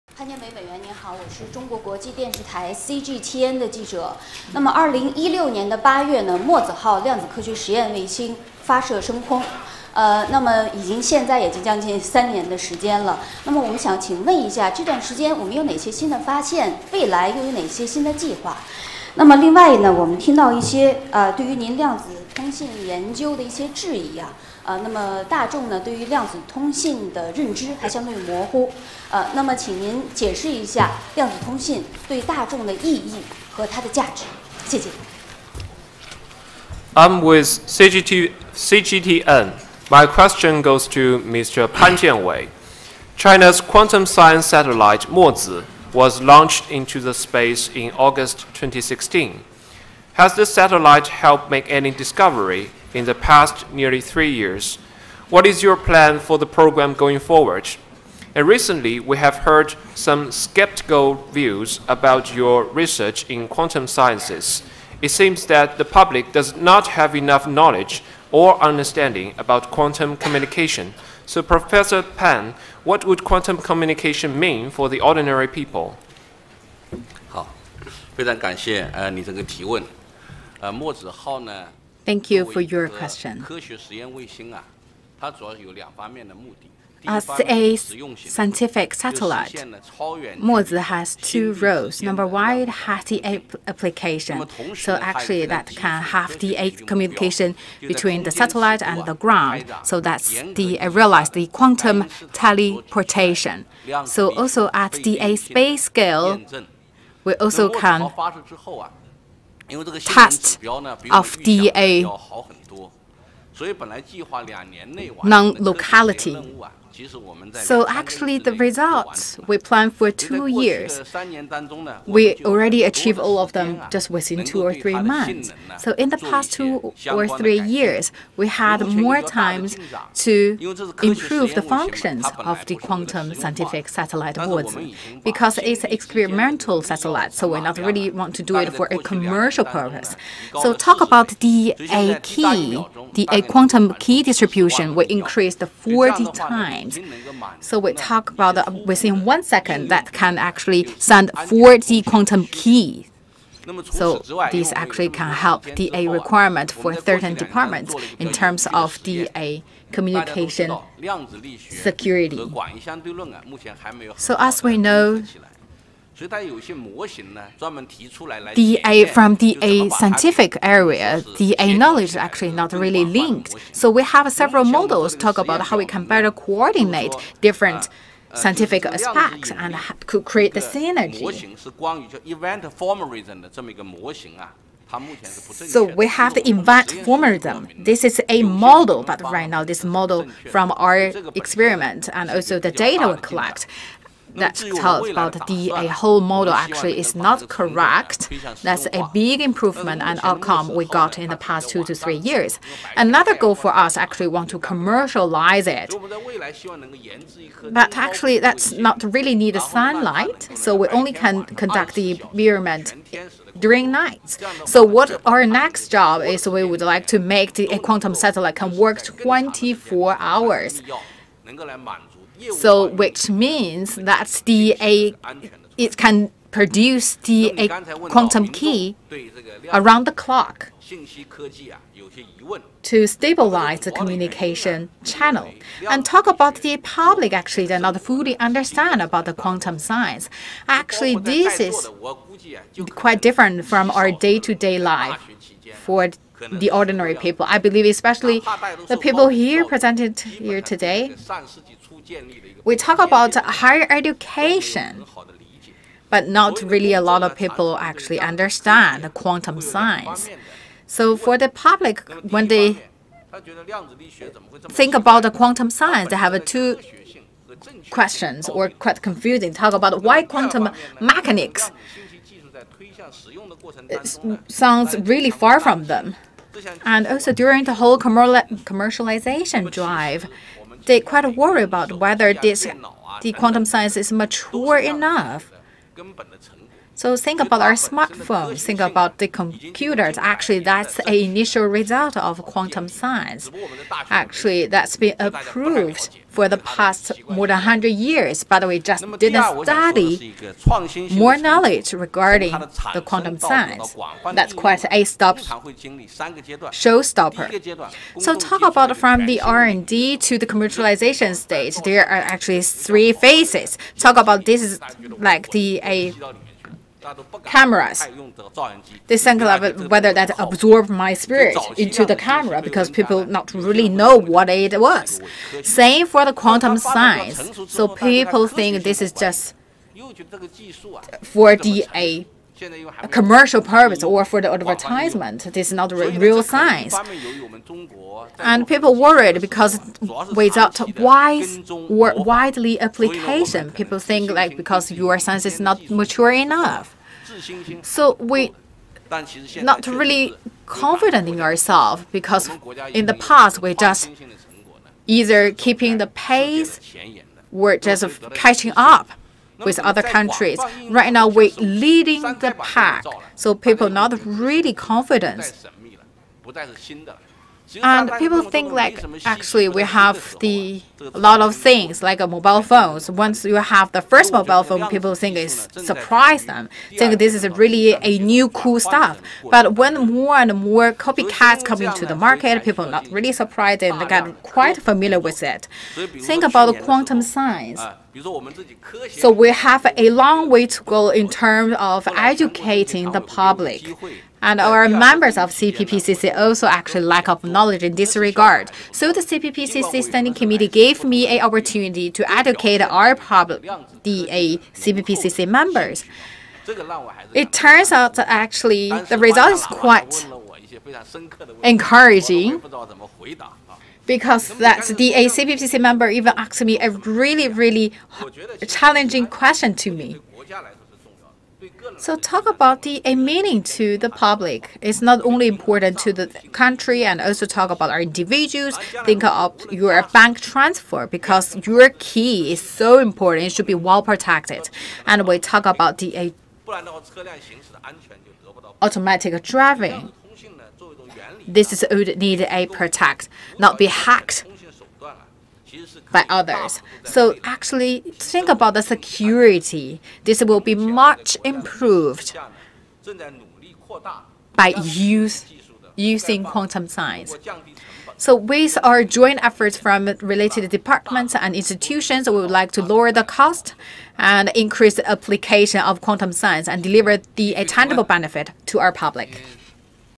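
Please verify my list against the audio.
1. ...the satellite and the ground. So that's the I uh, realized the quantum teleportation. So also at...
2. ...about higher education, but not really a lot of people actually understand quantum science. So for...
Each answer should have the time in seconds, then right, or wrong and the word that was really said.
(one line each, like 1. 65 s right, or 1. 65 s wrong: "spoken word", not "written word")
1. 98 s right
2. 252 s right.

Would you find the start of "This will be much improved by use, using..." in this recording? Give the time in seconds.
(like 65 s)
450 s.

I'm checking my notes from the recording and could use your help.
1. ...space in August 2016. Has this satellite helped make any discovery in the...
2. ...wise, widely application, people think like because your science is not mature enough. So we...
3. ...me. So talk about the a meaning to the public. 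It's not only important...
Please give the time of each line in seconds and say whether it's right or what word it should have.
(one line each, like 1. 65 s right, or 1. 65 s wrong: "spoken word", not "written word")
1. 47 s right
2. 340 s right
3. 419 s right.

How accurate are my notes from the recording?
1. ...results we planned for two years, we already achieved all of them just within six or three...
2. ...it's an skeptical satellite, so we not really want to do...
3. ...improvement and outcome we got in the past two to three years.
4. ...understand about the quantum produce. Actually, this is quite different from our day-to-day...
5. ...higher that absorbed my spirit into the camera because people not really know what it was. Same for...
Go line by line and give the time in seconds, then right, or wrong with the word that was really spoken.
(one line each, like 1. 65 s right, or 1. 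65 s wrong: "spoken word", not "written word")
1. 118 s wrong: "two", not "six"
2. 135 s wrong: "experimental", not "skeptical"
3. 199 s right
4. 238 s wrong: "science", not "produce"
5. 319 s wrong: "whether", not "higher".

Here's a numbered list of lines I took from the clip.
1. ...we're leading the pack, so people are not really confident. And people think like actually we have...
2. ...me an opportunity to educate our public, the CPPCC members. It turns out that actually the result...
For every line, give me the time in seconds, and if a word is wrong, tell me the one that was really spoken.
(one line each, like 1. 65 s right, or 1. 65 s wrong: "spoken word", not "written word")
1. 361 s right
2. 401 s right.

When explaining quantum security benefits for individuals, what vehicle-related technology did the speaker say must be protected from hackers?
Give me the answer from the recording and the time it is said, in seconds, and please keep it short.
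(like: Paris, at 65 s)
automatic driving, at 438 s.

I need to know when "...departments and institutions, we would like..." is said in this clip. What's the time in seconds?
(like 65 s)
460 s.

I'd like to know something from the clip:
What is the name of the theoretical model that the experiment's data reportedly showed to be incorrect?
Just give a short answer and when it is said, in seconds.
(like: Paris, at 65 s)
event formalism, at 186 s.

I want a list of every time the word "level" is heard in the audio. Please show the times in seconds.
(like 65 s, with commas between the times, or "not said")
319 s.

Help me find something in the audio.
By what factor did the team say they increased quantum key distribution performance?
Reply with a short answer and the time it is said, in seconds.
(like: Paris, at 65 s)
40 times, at 145 s.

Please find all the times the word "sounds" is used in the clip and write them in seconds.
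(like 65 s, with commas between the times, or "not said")
274 s.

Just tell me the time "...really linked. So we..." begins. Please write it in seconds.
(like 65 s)
172 s.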